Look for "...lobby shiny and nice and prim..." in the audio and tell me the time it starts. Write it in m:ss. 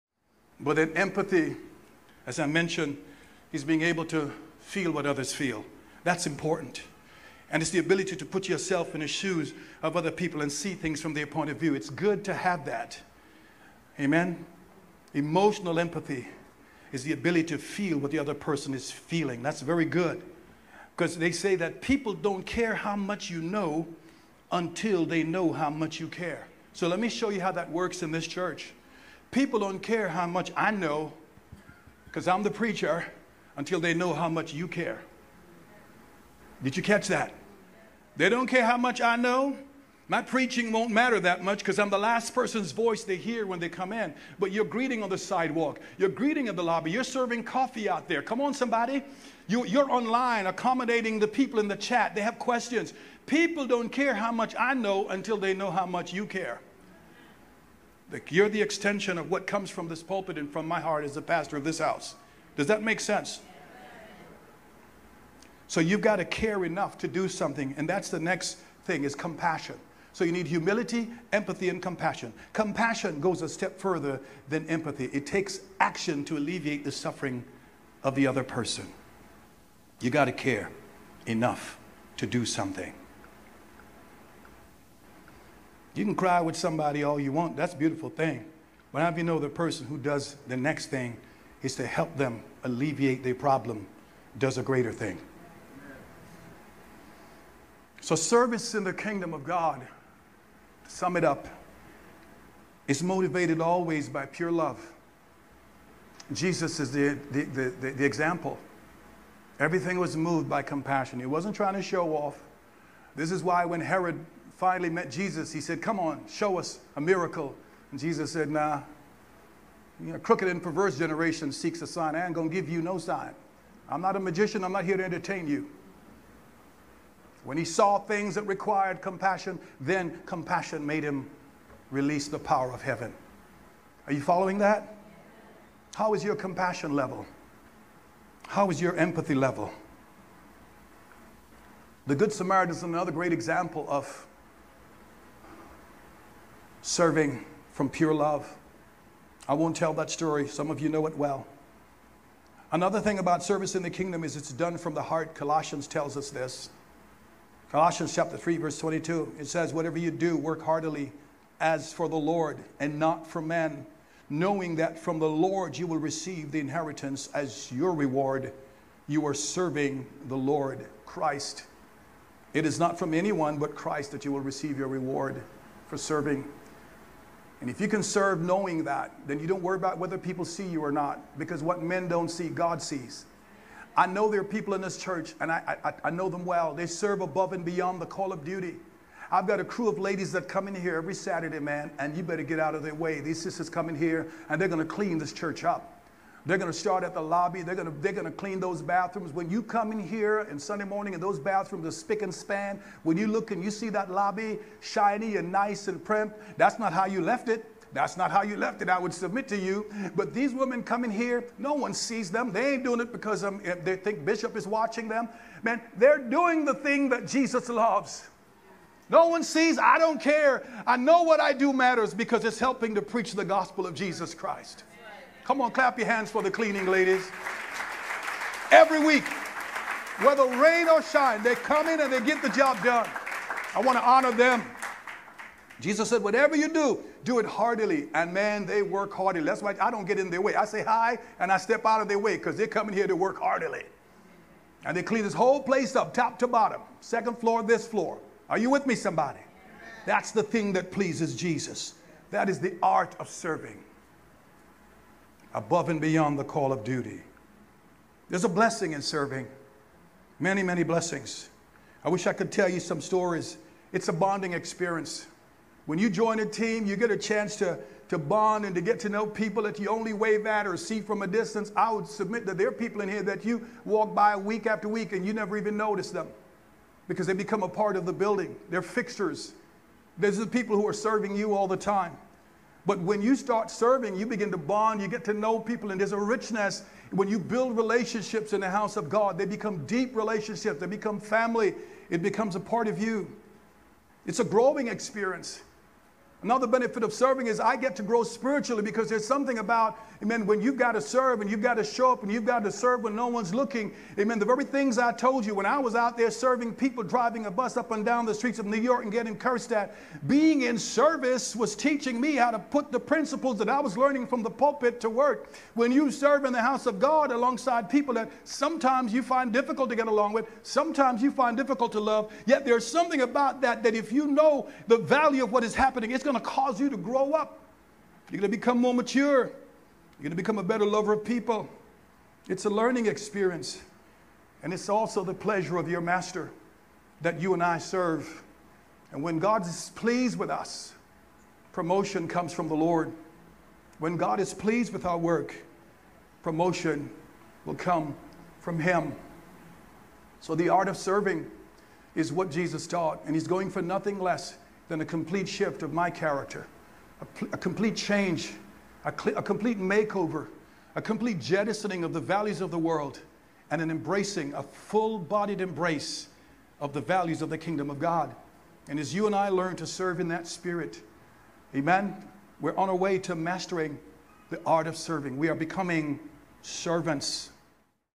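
3:24.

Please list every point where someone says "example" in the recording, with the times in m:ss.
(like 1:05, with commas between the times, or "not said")
1:48, 2:23.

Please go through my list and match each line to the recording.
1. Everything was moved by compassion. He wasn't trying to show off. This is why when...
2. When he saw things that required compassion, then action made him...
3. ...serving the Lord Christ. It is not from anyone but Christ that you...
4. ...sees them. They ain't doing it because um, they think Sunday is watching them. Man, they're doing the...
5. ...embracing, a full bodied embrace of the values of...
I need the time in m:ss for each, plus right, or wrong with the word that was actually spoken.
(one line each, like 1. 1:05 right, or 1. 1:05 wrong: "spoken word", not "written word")
1. 1:49 right
2. 2:07 wrong: "compassion", not "action"
3. 2:49 right
4. 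3:31 wrong: "Bishop", not "Sunday"
5. 6:03 right.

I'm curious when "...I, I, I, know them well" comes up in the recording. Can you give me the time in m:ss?
3:05.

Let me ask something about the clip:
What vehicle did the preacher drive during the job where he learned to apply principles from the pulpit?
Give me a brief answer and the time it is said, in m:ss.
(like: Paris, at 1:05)
A bus, at 5:07.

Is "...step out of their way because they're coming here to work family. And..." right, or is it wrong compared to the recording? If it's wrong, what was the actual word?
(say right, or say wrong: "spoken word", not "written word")
wrong: "heartily", not "family".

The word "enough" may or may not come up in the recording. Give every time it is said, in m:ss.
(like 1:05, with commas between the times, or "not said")
1:06, 1:21.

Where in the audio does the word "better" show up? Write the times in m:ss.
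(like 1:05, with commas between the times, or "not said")
3:12, 5:30.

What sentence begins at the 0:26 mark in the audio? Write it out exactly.
So let me show you how that works in this church.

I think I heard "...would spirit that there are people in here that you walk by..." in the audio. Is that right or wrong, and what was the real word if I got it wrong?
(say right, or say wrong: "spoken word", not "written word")
wrong: "submit", not "spirit".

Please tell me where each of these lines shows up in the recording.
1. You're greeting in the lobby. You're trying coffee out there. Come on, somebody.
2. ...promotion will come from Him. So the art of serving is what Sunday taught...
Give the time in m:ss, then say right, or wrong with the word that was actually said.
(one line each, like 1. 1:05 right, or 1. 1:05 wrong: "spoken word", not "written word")
1. 0:45 wrong: "serving", not "trying"
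2. 5:46 wrong: "Jesus", not "Sunday".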